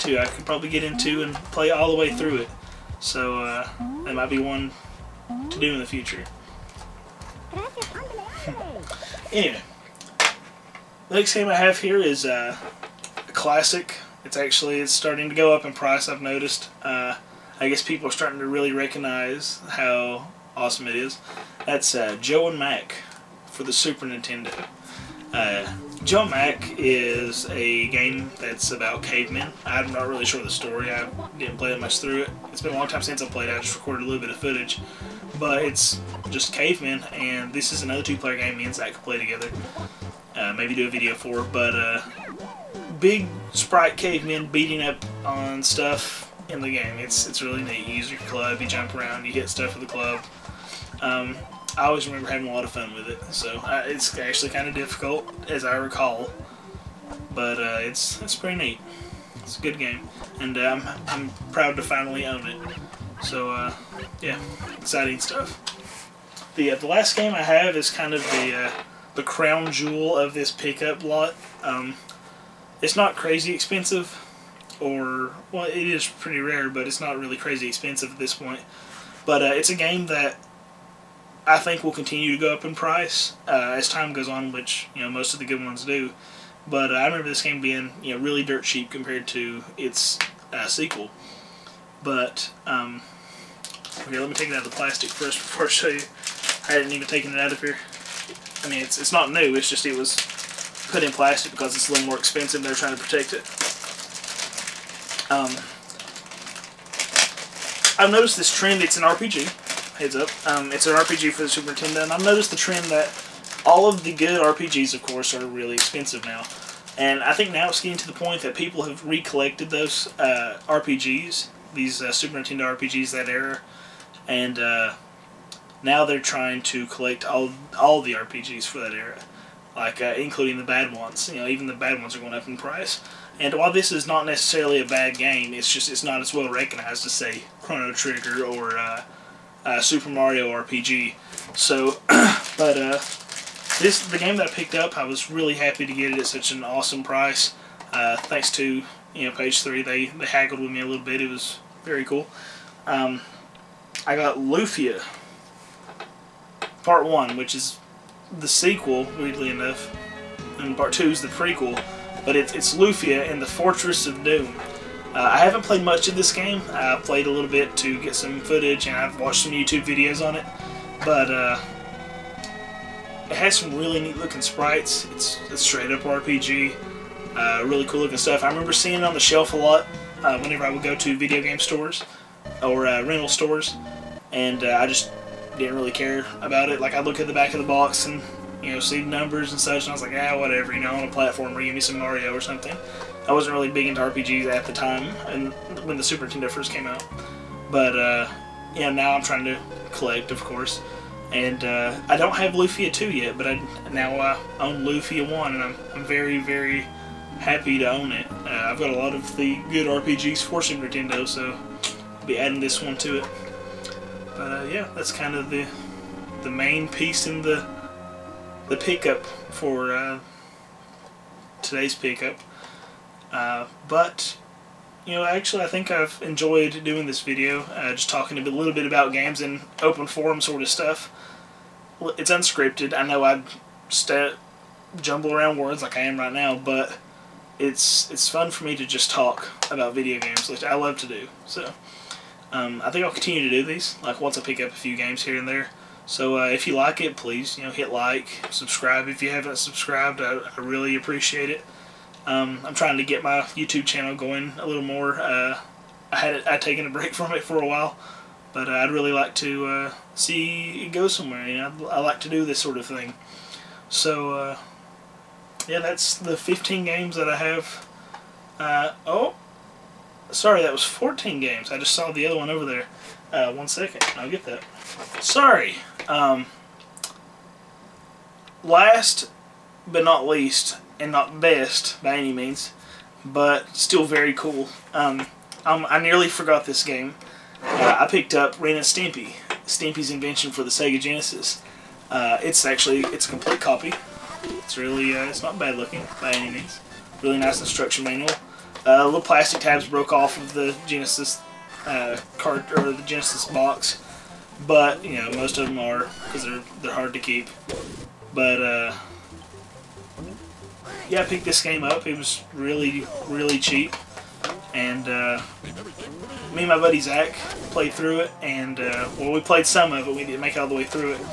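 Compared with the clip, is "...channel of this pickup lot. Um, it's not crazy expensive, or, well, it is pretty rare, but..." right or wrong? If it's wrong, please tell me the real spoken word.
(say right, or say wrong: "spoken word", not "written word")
wrong: "jewel", not "channel".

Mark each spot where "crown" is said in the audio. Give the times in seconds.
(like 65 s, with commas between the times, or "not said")
69 s.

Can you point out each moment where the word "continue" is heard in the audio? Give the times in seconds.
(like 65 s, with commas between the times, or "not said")
81 s, 243 s.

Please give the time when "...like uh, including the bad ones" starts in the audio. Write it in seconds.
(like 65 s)
129 s.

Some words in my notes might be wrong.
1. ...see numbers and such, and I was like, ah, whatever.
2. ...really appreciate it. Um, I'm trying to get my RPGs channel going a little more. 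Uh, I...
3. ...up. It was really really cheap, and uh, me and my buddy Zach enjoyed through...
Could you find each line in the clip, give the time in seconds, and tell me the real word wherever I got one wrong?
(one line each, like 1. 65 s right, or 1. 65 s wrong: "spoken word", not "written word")
1. 188 s right
2. 250 s wrong: "YouTube", not "RPGs"
3. 311 s wrong: "played", not "enjoyed".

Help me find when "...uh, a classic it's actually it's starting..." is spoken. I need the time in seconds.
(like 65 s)
12 s.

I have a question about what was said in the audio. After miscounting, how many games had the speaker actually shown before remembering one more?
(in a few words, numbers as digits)
14.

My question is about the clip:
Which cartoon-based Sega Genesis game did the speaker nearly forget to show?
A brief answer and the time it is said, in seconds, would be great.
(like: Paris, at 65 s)
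Ren and Stimpy, at 288 s.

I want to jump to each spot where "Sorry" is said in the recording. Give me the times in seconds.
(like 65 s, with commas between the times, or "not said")
270 s, 275 s.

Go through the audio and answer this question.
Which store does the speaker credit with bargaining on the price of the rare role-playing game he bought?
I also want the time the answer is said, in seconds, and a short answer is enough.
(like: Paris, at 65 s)
Page Three, at 149 s.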